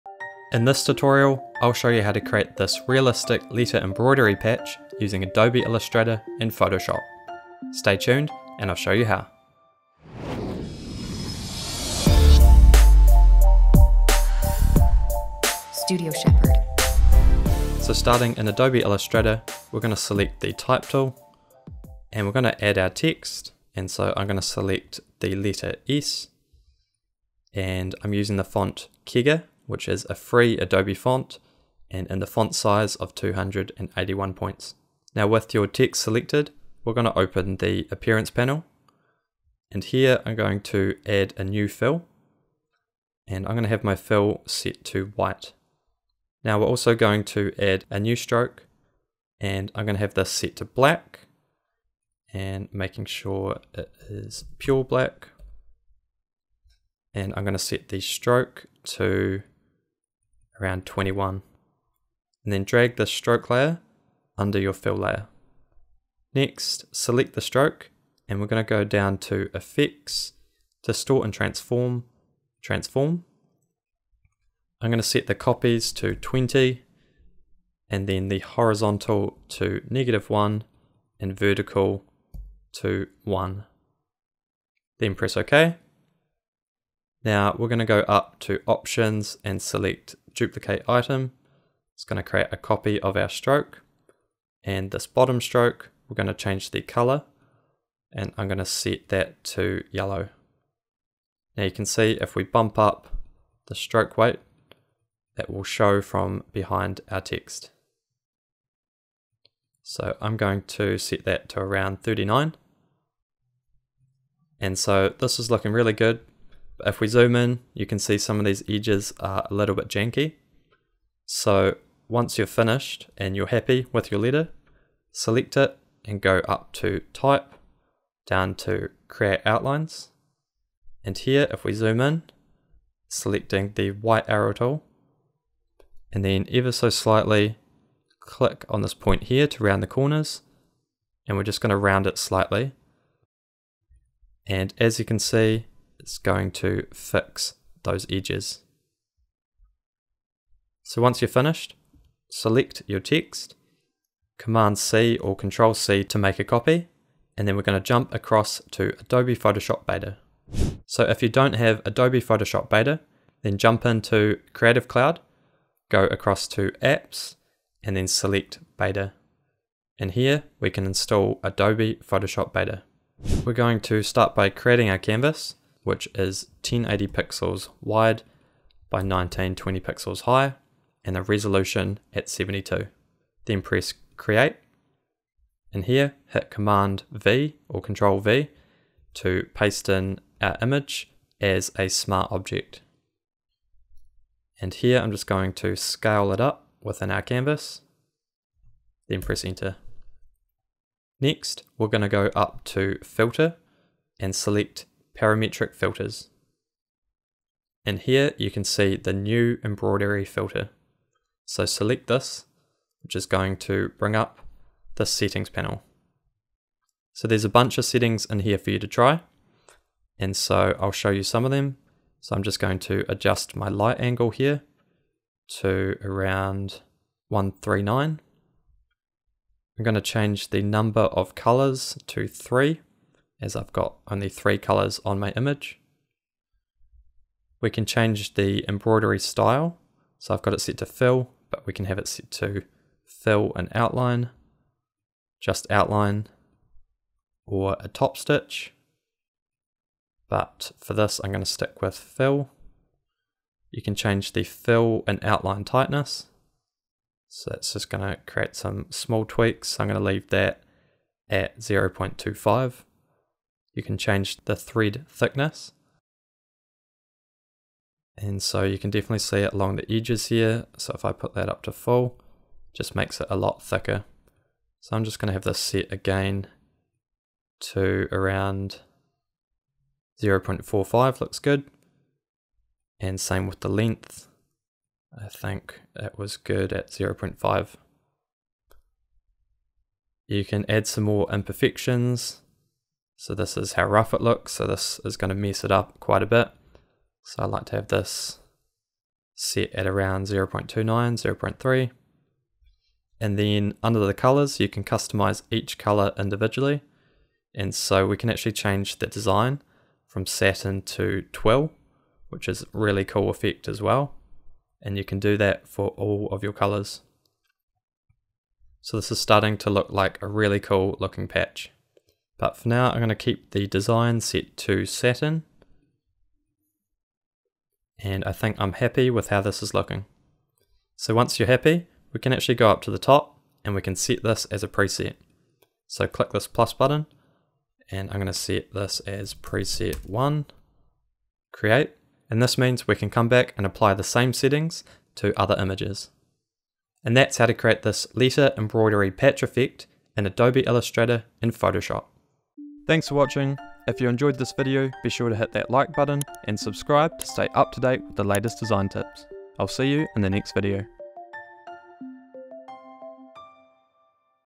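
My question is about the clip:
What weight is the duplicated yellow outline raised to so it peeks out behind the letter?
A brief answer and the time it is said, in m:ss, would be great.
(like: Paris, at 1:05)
39, at 1:52.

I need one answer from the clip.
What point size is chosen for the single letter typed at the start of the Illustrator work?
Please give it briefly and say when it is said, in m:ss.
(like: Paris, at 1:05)
281, at 0:33.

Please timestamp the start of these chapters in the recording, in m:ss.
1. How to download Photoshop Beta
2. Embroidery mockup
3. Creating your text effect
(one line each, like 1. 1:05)
1. 2:41
2. 2:54
3. 0:18.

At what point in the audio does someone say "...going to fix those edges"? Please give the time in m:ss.
2:26.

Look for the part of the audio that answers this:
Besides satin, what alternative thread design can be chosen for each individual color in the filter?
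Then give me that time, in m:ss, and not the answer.
5:11.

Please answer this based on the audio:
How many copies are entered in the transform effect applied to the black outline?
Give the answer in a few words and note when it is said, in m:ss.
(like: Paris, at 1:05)
20, at 1:16.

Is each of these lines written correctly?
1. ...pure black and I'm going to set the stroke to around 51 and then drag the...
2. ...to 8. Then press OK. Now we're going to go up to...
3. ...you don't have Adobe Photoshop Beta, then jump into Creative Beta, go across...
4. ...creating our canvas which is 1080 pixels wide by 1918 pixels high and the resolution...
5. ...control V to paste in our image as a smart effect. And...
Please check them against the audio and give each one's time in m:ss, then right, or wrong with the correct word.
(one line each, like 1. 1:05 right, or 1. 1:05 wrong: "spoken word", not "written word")
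1. 0:54 wrong: "21", not "51"
2. 1:22 wrong: "1", not "8"
3. 2:41 wrong: "Cloud", not "Beta"
4. 2:54 wrong: "1920", not "1918"
5. 3:07 wrong: "object", not "effect".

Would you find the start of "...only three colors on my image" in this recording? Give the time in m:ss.
3:54.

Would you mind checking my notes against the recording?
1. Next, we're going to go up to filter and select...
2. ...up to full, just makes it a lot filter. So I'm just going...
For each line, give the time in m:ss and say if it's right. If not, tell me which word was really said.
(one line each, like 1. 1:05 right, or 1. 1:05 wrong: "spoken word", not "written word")
1. 3:21 right
2. 4:31 wrong: "thicker", not "filter".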